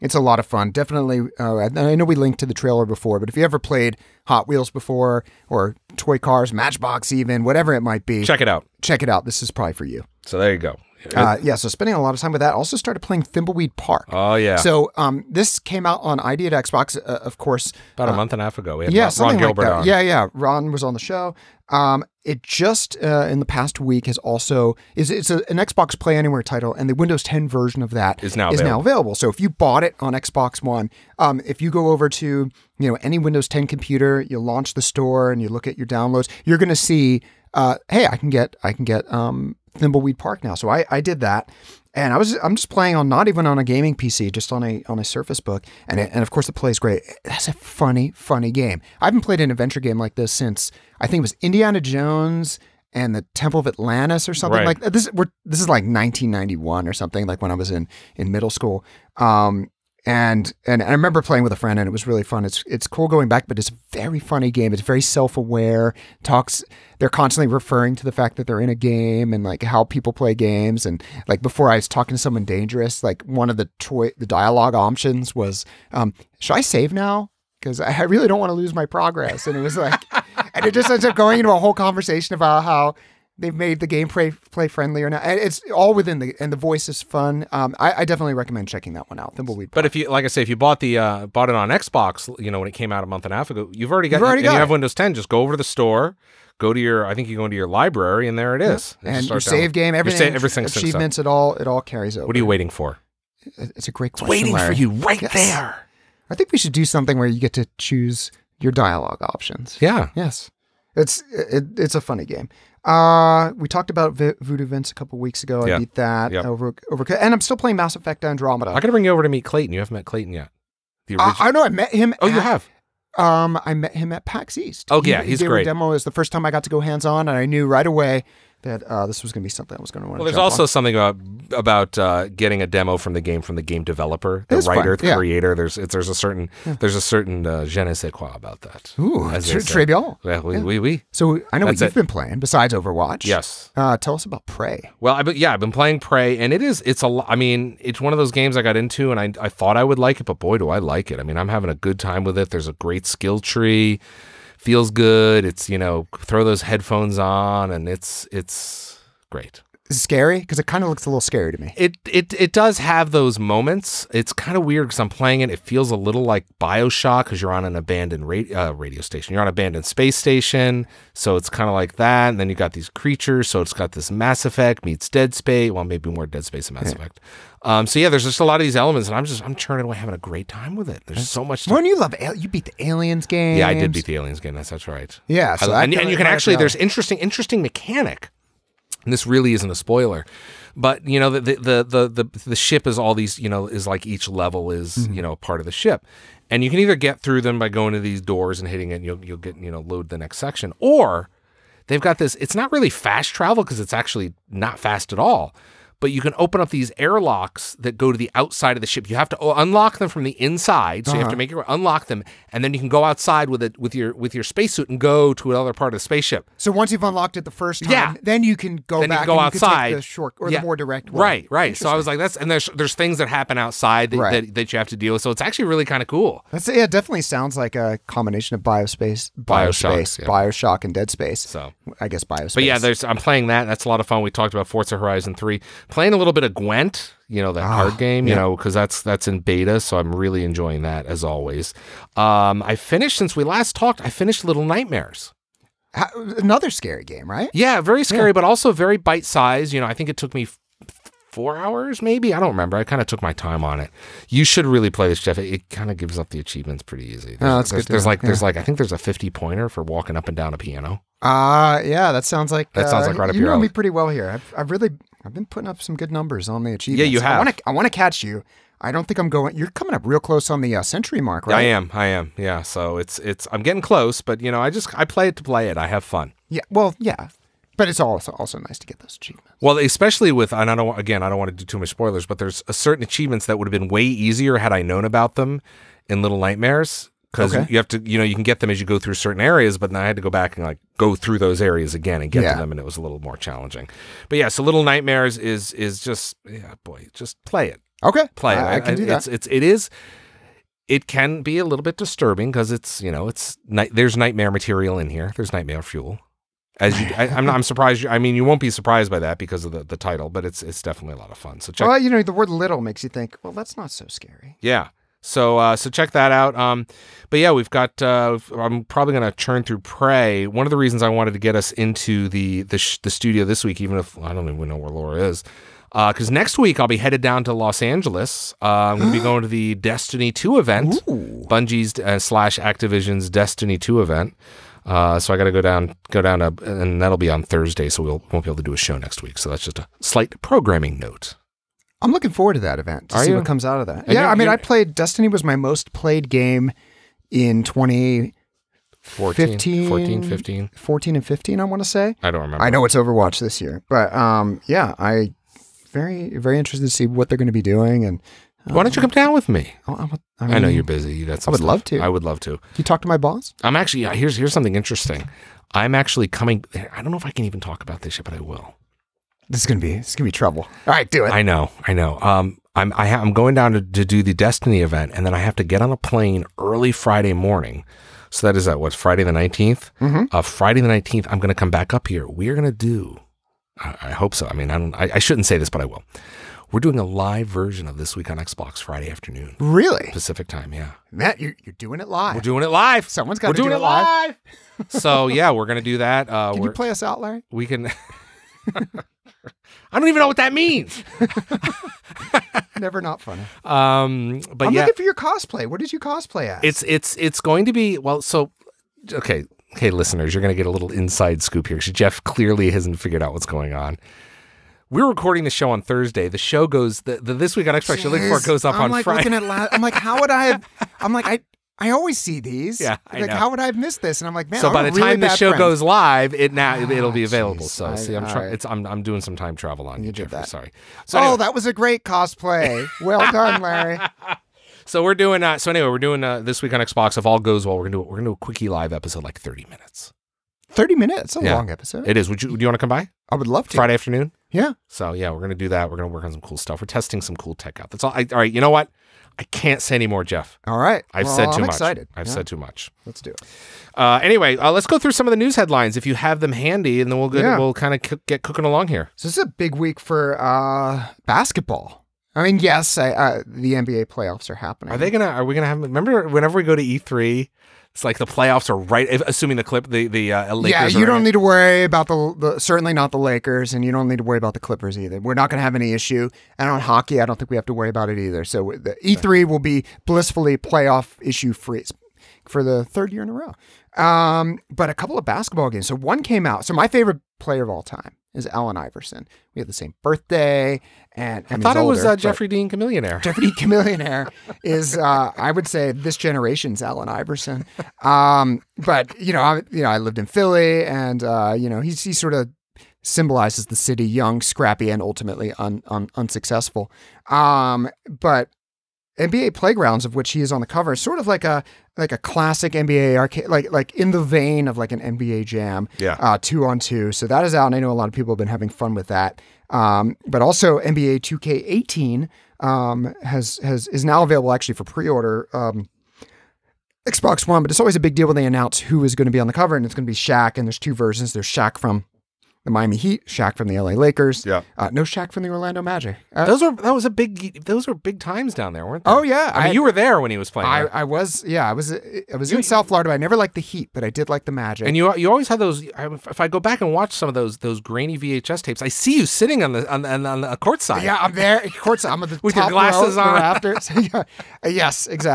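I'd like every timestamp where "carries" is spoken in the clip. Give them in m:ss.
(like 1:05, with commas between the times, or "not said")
1:41.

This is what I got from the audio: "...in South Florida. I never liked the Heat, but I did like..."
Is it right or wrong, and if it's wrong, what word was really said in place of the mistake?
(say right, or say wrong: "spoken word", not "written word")
right.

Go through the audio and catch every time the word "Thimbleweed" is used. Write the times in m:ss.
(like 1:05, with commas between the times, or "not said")
0:13, 0:39, 1:29.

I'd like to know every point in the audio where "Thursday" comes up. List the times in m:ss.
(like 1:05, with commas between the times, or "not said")
5:37, 6:55.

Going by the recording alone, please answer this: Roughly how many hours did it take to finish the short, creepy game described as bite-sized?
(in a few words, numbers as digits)
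4.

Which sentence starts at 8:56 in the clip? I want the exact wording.
Uh, those were that was a big those were big times down there, weren't they?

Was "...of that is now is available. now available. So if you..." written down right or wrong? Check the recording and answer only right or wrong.
right.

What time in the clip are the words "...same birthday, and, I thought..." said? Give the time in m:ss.
8:09.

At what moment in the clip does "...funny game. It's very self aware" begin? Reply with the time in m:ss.
1:04.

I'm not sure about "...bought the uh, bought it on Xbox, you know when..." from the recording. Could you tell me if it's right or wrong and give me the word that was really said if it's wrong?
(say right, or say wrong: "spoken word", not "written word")
right.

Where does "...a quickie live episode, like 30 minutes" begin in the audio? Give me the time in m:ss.
7:18.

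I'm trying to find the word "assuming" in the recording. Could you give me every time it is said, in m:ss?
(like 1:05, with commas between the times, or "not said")
7:49.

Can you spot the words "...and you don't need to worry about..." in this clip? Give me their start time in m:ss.
7:53.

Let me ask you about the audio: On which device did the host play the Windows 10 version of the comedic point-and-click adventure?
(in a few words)
Surface Book.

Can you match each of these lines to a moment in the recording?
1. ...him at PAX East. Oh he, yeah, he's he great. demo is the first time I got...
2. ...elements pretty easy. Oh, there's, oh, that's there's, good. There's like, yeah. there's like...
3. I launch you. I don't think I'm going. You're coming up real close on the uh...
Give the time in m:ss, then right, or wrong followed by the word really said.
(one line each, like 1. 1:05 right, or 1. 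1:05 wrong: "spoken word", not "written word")
1. 2:03 right
2. 4:16 wrong: "achievements", not "elements"
3. 4:27 wrong: "catch", not "launch".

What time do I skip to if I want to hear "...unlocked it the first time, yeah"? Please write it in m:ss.
3:37.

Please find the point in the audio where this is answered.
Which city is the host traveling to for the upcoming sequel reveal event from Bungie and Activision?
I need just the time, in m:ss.
5:27.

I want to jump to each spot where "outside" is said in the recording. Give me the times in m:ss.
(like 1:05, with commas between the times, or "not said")
3:28, 3:33, 3:39, 3:43.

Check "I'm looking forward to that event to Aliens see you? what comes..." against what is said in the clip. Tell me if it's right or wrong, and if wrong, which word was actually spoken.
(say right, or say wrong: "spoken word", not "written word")
wrong: "Are", not "Aliens".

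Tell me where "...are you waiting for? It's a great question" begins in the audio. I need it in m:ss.
1:42.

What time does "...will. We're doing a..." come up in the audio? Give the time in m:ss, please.
6:25.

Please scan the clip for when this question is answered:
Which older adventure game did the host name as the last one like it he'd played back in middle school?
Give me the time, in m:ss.
0:51.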